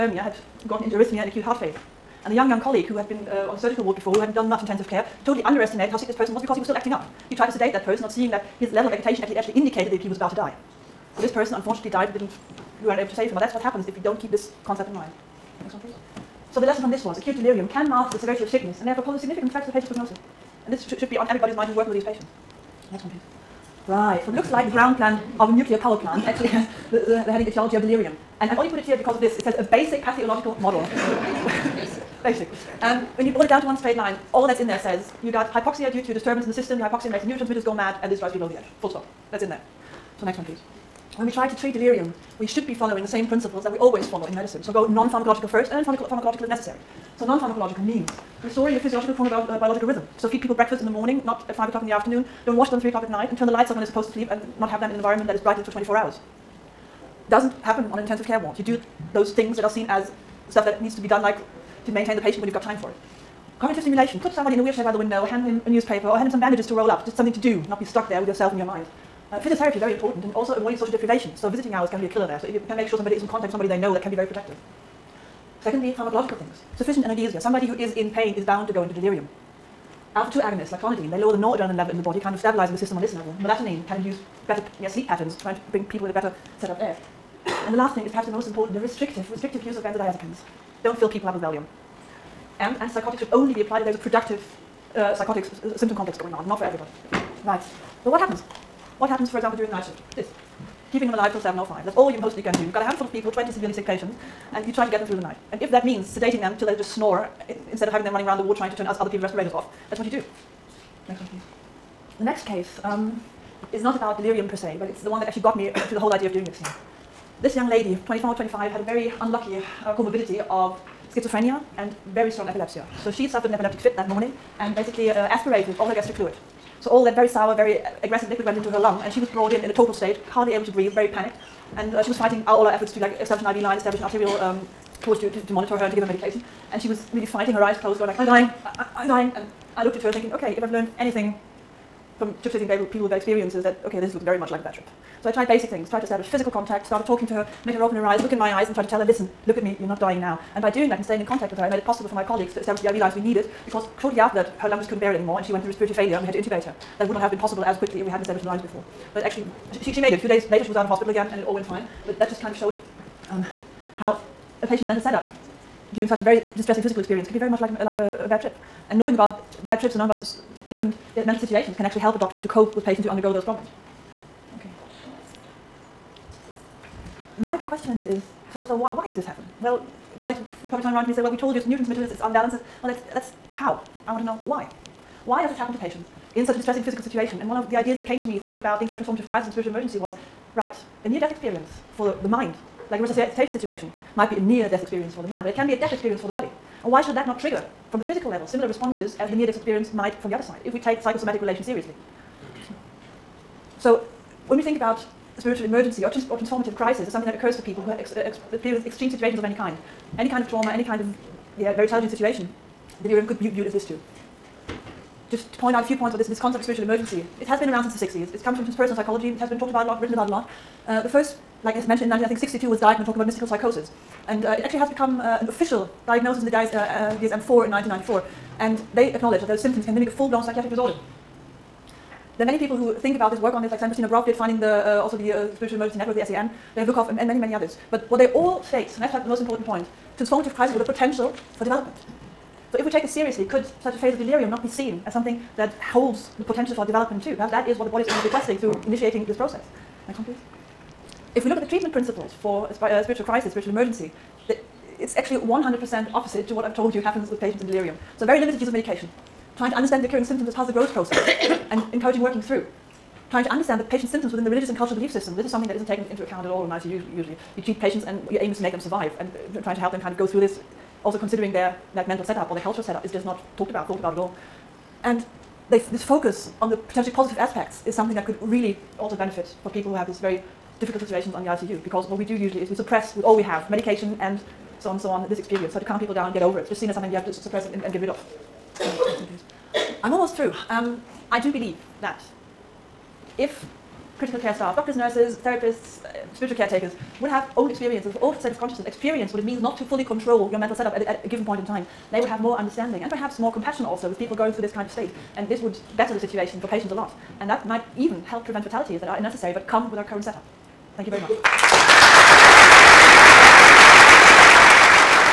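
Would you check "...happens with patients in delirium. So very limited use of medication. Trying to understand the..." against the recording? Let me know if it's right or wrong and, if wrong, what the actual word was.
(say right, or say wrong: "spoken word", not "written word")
right.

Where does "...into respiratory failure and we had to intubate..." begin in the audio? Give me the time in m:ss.
2:35.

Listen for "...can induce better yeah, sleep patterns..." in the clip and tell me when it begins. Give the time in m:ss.
1:23.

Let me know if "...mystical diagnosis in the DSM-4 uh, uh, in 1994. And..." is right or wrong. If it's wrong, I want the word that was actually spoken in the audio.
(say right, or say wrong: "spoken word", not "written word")
wrong: "official", not "mystical".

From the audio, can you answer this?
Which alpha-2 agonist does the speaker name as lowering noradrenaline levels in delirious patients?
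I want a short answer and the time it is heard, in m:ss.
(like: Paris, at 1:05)
clonidine, at 1:20.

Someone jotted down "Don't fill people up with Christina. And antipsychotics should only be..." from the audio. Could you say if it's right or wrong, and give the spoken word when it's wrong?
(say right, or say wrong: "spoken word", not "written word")
wrong: "Valium", not "Christina".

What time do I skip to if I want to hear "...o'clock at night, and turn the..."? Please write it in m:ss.
0:52.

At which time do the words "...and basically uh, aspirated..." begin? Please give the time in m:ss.
2:04.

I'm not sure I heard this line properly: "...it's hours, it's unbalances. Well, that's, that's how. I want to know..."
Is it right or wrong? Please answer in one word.
wrong.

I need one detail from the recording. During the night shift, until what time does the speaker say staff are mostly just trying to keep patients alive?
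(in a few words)
7:05.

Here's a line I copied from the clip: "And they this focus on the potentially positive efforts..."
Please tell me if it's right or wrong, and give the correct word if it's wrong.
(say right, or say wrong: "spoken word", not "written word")
wrong: "aspects", not "efforts".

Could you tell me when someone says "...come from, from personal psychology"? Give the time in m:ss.
3:38.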